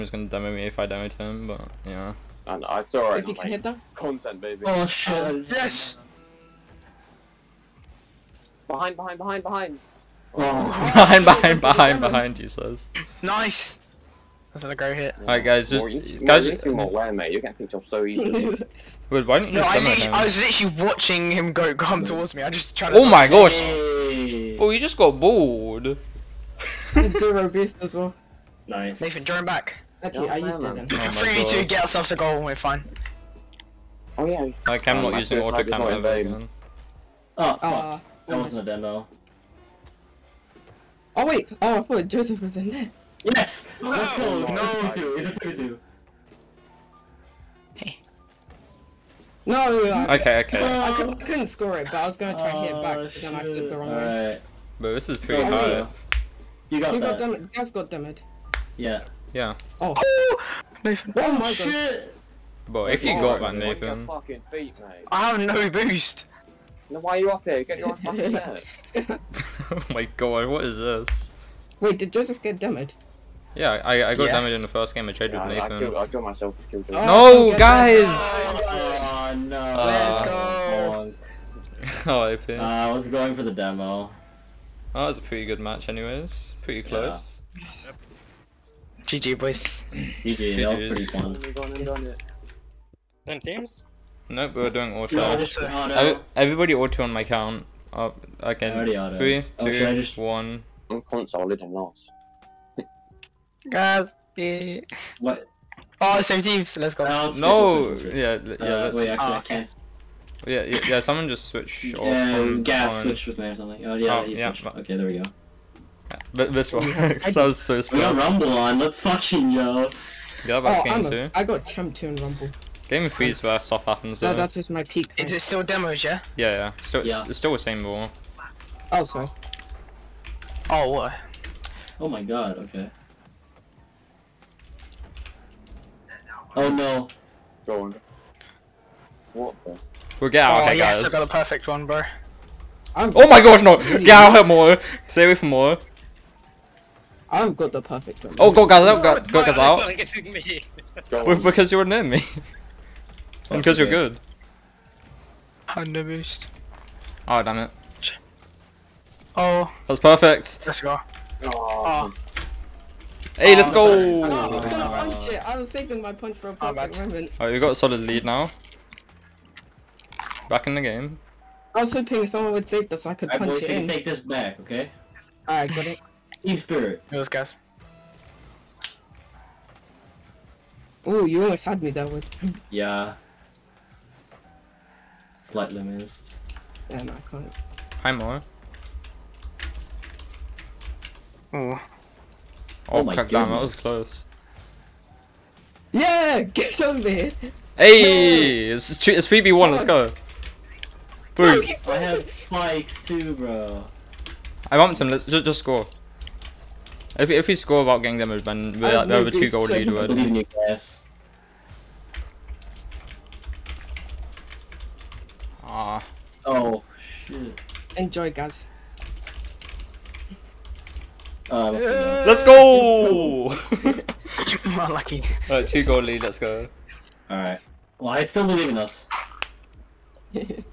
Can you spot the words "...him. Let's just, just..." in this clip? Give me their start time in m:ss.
3:25.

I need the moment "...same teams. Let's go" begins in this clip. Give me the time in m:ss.
1:46.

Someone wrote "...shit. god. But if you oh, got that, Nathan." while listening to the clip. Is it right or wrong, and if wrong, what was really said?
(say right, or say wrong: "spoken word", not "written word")
right.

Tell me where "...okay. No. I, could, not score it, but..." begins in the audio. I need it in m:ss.
0:50.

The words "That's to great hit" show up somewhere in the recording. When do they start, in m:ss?
0:14.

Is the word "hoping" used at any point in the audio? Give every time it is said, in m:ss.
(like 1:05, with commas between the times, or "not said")
2:51.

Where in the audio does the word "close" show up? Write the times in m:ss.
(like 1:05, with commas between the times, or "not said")
1:26, 3:13.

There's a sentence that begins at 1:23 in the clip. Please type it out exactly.
Oh, that was a pretty good match anyways.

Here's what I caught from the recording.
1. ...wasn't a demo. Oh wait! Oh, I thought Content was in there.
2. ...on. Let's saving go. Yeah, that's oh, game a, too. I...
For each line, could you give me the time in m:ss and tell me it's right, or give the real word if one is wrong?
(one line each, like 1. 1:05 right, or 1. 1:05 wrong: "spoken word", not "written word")
1. 0:38 wrong: "Joseph", not "Content"
2. 1:58 wrong: "fucking", not "saving".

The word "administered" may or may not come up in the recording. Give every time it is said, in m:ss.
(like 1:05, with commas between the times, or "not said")
not said.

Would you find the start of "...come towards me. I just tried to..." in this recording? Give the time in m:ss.
0:21.